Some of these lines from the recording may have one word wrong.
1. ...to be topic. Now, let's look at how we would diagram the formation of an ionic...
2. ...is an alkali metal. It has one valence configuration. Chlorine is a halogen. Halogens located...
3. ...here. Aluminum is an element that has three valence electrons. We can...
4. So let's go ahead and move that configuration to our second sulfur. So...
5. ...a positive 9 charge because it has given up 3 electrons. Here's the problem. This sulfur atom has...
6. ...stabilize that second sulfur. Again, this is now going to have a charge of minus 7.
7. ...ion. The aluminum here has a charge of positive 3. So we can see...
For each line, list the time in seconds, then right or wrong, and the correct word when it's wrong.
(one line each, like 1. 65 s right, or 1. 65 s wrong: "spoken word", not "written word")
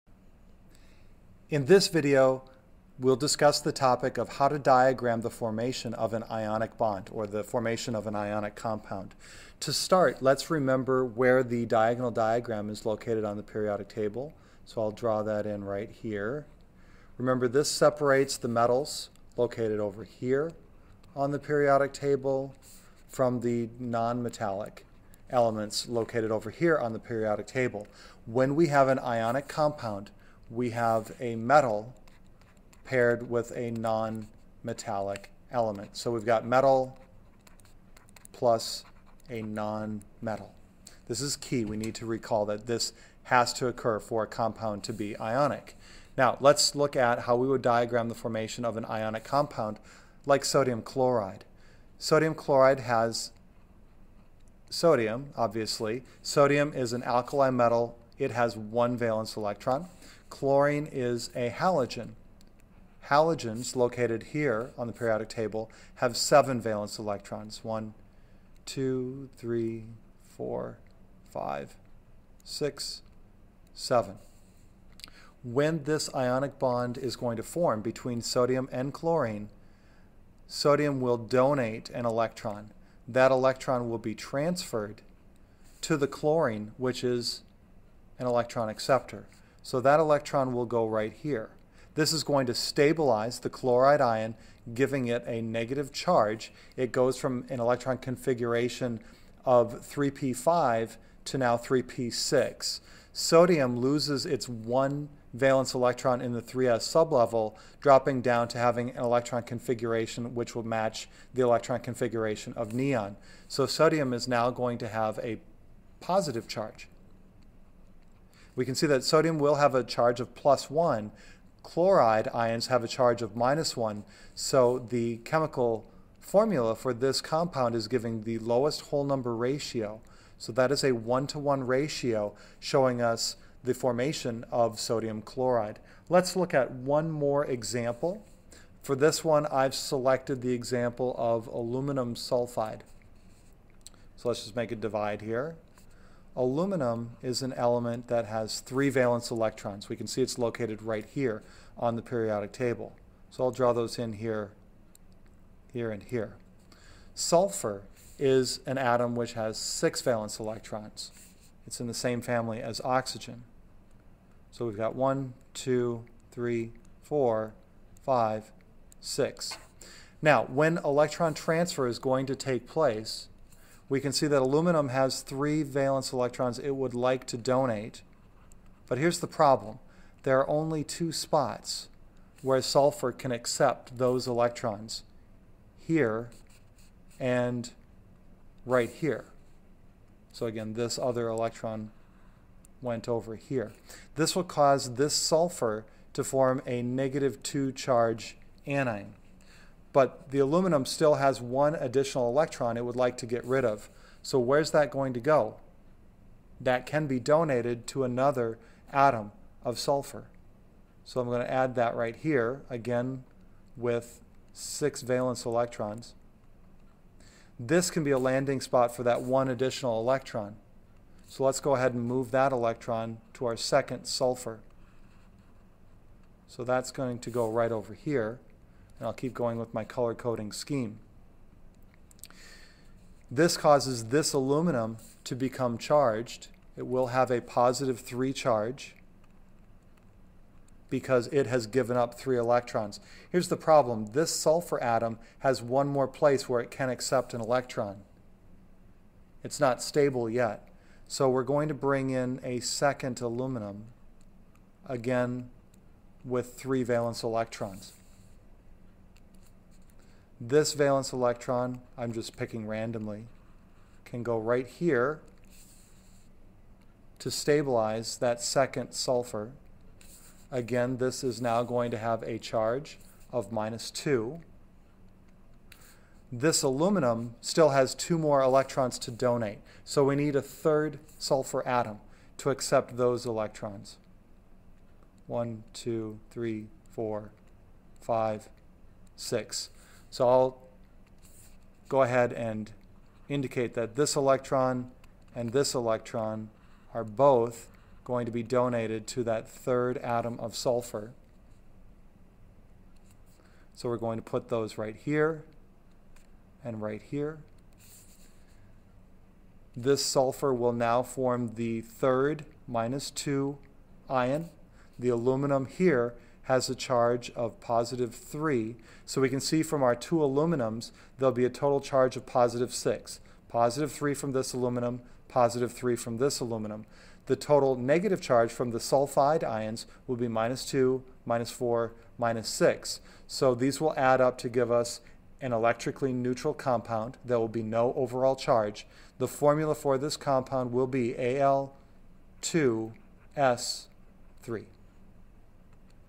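1. 44 s wrong: "ionic", not "topic"
2. 56 s wrong: "electron", not "configuration"
3. 145 s right
4. 221 s wrong: "electron", not "configuration"
5. 237 s wrong: "3", not "9"
6. 267 s wrong: "2", not "7"
7. 314 s right.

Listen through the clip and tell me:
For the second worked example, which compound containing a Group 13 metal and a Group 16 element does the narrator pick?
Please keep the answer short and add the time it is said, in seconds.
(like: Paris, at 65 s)
aluminum sulfide, at 141 s.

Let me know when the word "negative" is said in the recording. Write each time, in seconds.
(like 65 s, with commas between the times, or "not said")
95 s, 196 s, 327 s.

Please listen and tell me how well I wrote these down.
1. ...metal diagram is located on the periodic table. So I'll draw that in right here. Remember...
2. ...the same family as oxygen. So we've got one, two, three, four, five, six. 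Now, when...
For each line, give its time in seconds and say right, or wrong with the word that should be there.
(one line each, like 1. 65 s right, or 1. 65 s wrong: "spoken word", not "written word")
1. 11 s wrong: "diagonal", not "metal"
2. 161 s right.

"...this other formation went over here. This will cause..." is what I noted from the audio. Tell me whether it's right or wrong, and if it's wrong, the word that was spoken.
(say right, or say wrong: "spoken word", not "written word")
wrong: "electron", not "formation".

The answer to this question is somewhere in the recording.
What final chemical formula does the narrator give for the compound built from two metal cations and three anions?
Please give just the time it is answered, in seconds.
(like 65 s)
341 s.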